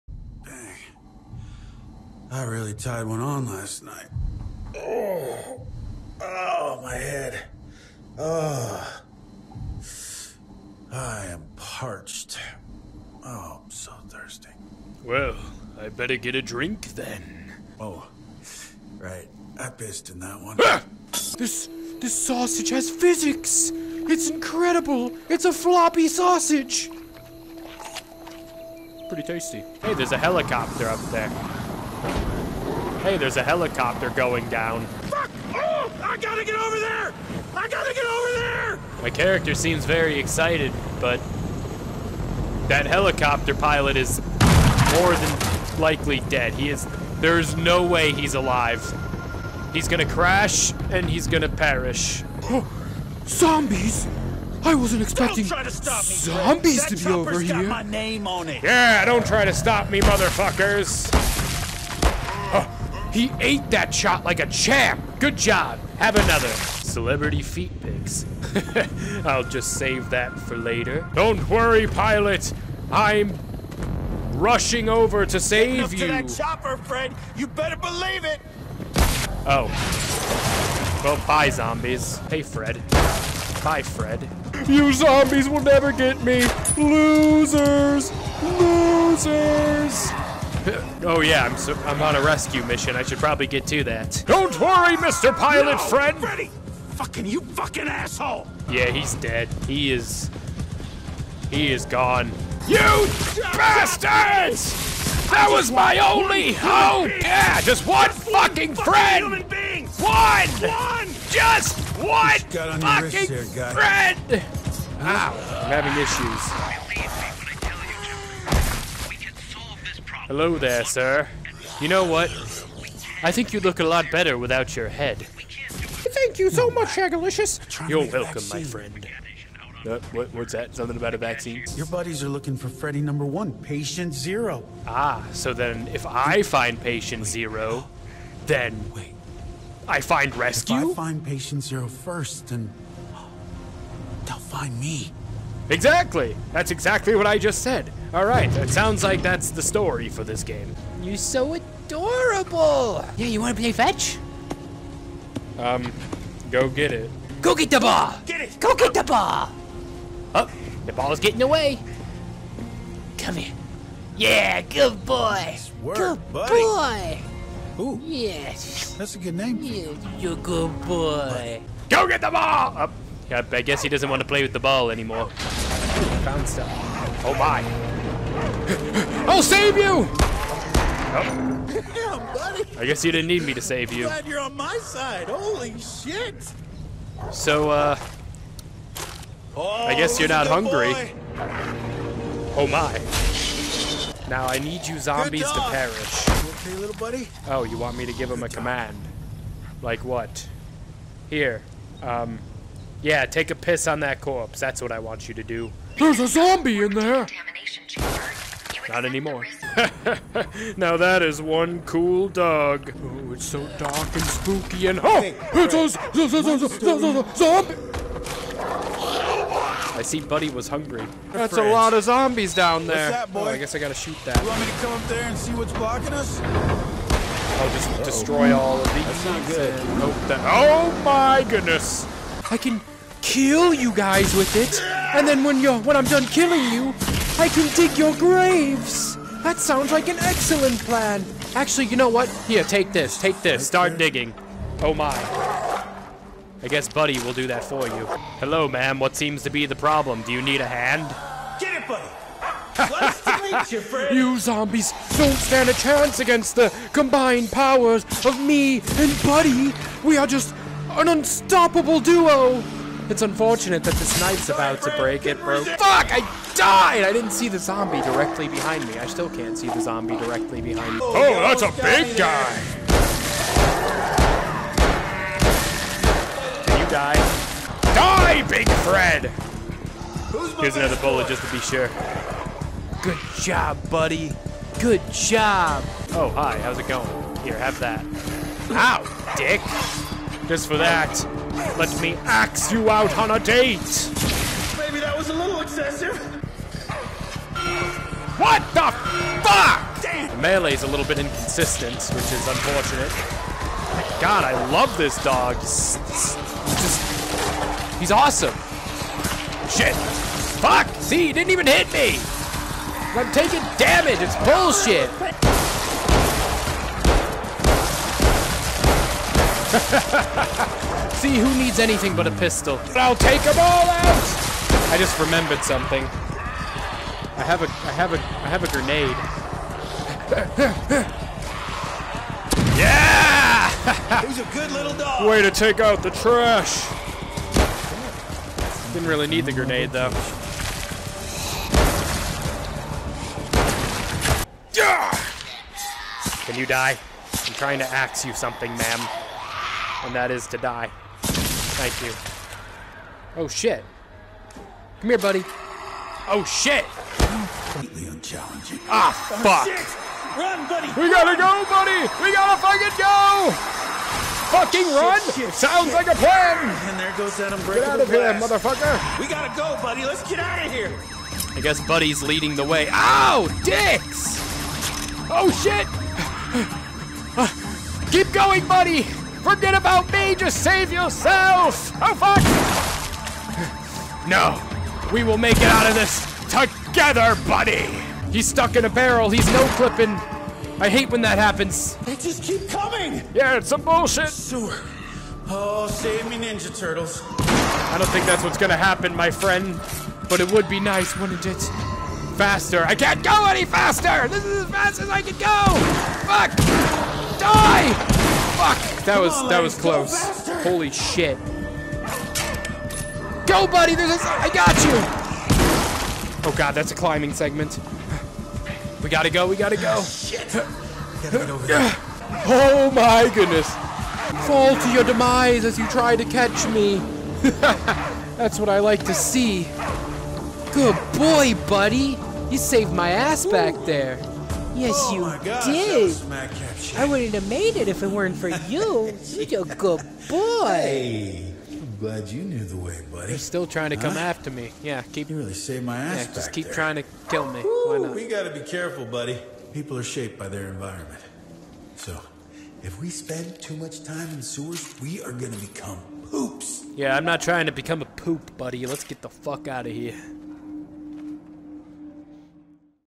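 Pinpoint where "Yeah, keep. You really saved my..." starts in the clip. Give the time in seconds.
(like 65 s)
444 s.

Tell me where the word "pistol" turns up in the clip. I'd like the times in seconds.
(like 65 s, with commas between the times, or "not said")
322 s.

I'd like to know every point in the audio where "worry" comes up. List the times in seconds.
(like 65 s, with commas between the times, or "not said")
71 s, 94 s.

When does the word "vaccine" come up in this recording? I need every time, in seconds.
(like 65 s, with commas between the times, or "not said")
131 s.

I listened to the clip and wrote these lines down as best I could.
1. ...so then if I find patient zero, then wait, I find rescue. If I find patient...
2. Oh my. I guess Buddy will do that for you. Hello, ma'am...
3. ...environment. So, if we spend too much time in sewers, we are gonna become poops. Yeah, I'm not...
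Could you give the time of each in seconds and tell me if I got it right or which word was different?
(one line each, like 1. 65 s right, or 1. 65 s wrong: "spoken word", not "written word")
1. 135 s right
2. 244 s right
3. 450 s right.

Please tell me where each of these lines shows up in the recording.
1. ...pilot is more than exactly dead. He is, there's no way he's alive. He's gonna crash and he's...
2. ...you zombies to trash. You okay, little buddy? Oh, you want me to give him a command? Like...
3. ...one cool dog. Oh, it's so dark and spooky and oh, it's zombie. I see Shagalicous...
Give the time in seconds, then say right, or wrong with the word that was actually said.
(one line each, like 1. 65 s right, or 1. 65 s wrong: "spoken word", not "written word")
1. 43 s wrong: "likely", not "exactly"
2. 194 s wrong: "perish", not "trash"
3. 211 s wrong: "Buddy", not "Shagalicous".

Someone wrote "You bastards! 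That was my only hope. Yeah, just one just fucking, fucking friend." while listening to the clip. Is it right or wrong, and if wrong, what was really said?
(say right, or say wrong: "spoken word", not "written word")
right.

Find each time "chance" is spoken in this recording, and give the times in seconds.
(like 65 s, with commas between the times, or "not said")
255 s.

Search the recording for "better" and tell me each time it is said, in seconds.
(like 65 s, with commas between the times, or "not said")
15 s, 77 s, 124 s.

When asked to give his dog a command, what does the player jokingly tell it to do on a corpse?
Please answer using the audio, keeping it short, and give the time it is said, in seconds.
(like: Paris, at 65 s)
take a piss, at 203 s.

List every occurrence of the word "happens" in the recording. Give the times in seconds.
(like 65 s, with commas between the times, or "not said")
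391 s, 398 s.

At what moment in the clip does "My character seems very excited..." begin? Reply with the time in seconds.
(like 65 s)
39 s.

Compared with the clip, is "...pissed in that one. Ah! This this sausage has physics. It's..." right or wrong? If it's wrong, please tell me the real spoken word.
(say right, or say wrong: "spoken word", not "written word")
right.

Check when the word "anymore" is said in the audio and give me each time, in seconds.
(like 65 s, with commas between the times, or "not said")
174 s, 209 s.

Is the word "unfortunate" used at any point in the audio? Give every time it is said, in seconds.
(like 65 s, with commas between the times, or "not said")
263 s, 302 s.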